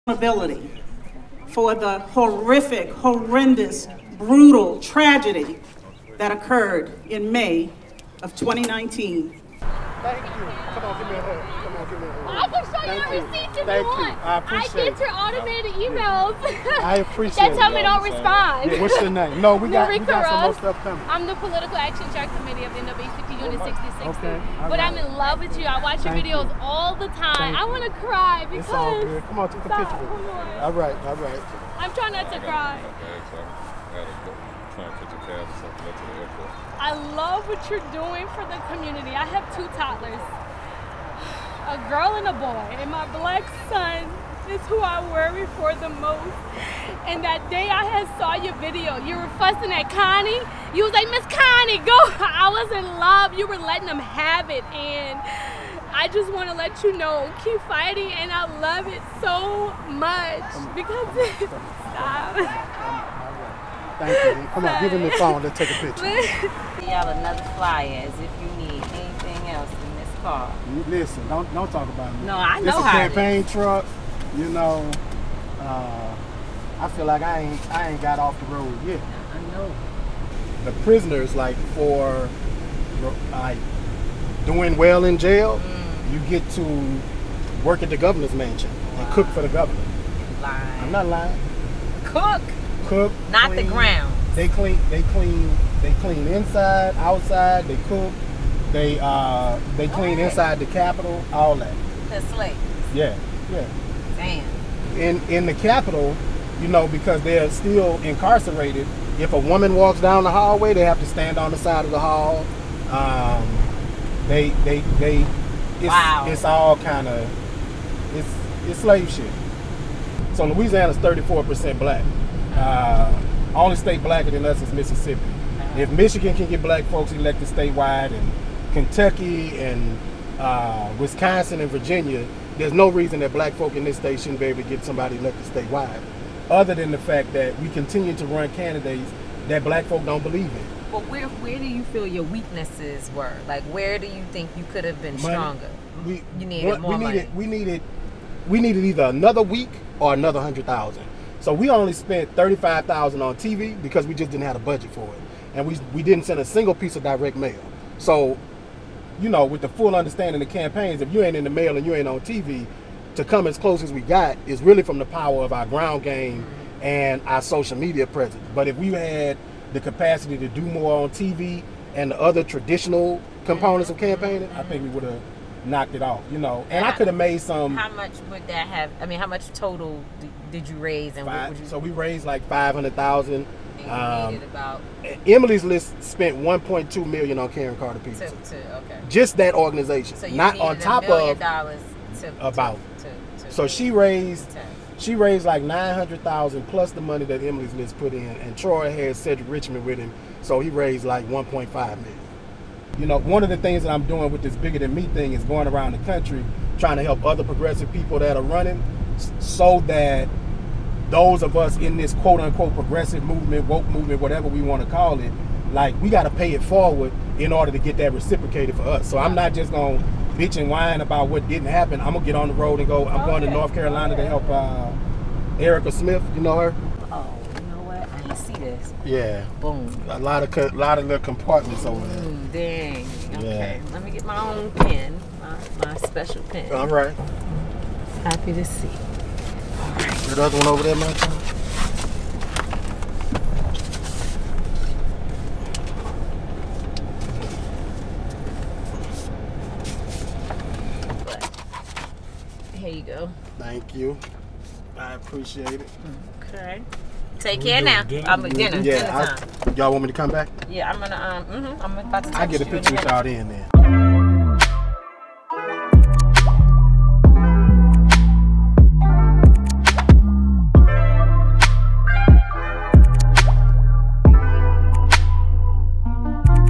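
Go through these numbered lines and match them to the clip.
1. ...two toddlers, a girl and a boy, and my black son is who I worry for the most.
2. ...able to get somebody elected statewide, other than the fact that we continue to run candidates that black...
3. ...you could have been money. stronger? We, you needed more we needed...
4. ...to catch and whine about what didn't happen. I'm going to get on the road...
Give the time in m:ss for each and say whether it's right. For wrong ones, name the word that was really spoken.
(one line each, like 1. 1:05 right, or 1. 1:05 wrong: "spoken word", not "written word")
1. 0:39 right
2. 2:14 right
3. 2:24 right
4. 3:39 wrong: "bitch", not "catch".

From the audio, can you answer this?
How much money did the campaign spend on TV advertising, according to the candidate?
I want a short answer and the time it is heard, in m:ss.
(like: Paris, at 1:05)
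$35,000, at 2:32.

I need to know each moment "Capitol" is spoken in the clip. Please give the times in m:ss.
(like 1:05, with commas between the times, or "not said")
1:40, 1:45.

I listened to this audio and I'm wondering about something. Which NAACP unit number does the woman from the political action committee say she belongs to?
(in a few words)
66.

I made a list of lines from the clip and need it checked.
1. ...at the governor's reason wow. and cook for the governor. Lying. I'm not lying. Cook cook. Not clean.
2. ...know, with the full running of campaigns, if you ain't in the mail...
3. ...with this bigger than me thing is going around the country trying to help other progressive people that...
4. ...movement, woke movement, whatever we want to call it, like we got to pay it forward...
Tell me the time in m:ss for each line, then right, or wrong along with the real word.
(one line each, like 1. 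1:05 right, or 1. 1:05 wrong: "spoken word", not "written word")
1. 1:27 wrong: "mansion", not "reason"
2. 2:39 wrong: "understanding", not "running"
3. 3:24 right
4. 3:33 right.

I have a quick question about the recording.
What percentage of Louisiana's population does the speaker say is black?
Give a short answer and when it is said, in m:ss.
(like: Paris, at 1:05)
34%, at 2:00.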